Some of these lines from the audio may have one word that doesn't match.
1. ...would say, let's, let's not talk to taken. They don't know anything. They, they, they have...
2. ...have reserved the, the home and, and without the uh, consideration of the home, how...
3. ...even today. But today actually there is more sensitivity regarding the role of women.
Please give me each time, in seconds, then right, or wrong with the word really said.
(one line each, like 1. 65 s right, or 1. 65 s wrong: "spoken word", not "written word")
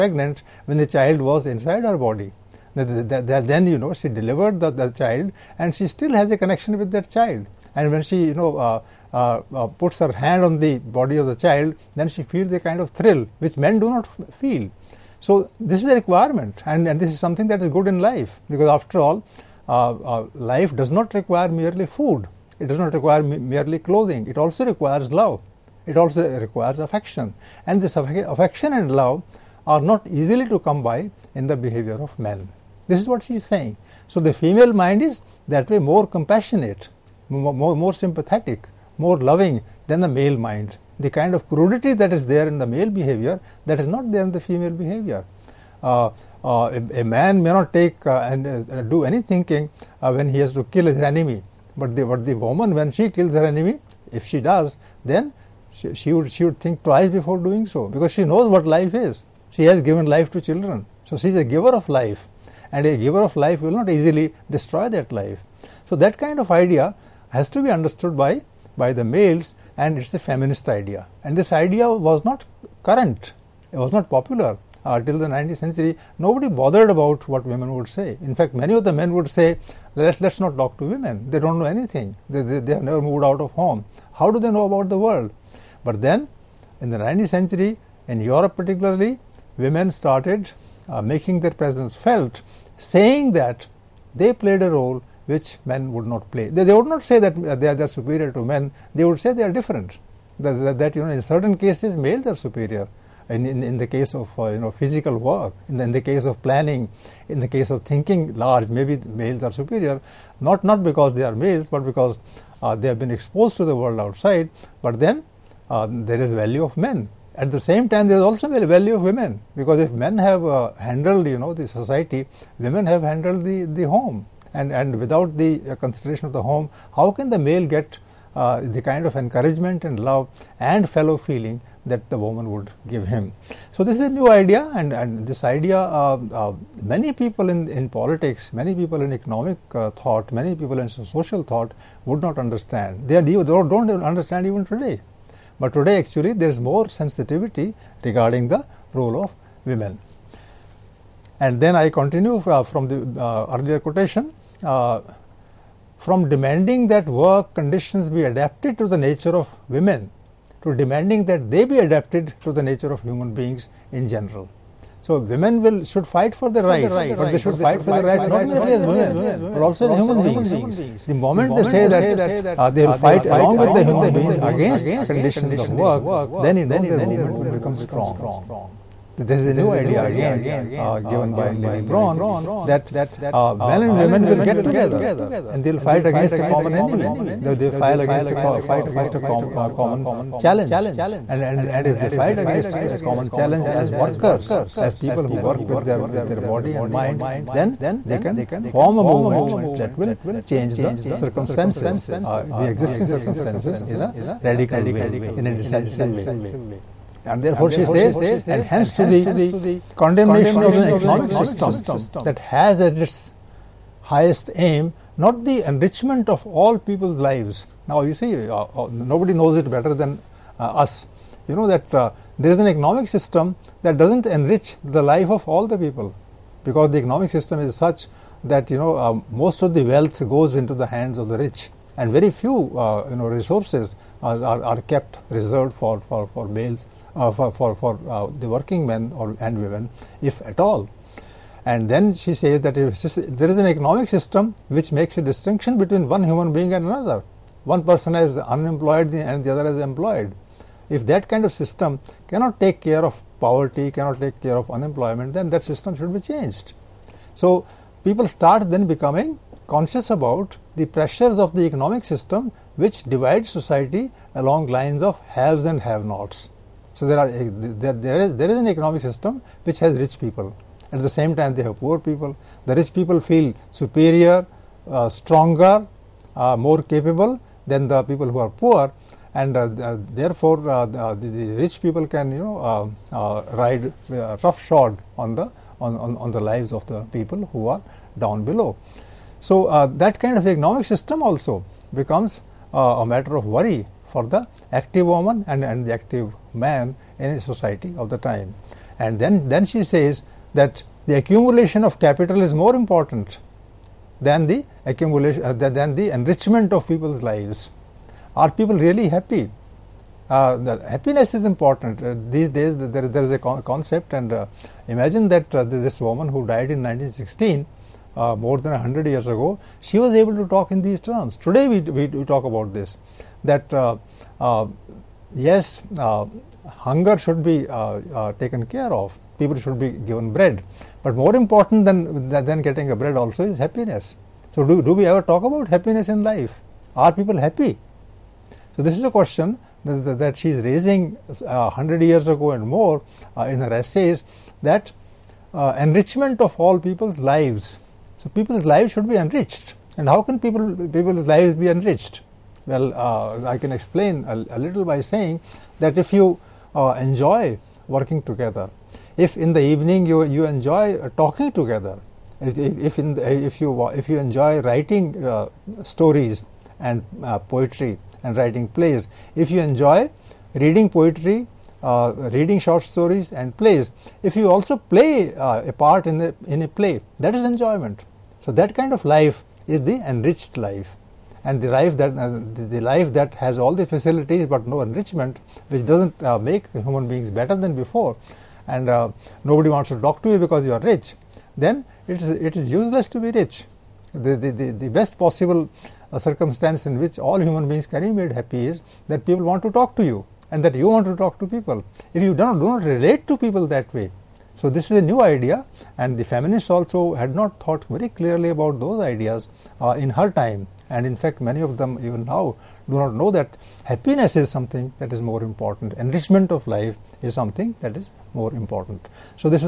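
1. 79 s wrong: "women", not "taken"
2. 122 s wrong: "handled", not "reserved"
3. 144 s right.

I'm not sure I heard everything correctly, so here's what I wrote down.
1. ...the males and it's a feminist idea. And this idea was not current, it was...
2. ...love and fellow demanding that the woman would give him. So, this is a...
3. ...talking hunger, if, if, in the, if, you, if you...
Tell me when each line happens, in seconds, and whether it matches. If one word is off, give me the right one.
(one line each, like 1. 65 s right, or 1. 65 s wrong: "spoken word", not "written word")
1. 68 s right
2. 130 s wrong: "feeling", not "demanding"
3. 361 s wrong: "together", not "hunger".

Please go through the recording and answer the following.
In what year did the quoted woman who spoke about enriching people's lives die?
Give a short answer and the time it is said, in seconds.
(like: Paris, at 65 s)
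1916, at 316 s.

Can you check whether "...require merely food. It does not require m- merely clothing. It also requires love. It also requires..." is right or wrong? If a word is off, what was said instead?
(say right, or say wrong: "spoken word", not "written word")
right.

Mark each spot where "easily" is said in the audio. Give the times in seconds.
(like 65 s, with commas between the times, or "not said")
30 s, 63 s.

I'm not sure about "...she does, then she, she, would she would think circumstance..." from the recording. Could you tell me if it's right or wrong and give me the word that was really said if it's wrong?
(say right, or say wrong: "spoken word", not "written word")
wrong: "twice", not "circumstance".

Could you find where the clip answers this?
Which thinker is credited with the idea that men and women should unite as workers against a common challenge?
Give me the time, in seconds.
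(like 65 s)
181 s.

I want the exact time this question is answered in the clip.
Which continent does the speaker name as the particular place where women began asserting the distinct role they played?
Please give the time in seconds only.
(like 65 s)
88 s.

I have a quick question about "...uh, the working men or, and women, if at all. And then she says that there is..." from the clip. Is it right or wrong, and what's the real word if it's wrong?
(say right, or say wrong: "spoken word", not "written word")
right.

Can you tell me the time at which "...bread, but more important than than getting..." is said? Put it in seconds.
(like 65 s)
330 s.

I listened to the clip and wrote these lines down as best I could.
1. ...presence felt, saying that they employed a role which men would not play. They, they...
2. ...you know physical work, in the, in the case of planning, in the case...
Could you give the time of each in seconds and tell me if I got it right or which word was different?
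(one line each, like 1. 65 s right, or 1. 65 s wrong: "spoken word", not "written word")
1. 91 s wrong: "played", not "employed"
2. 104 s right.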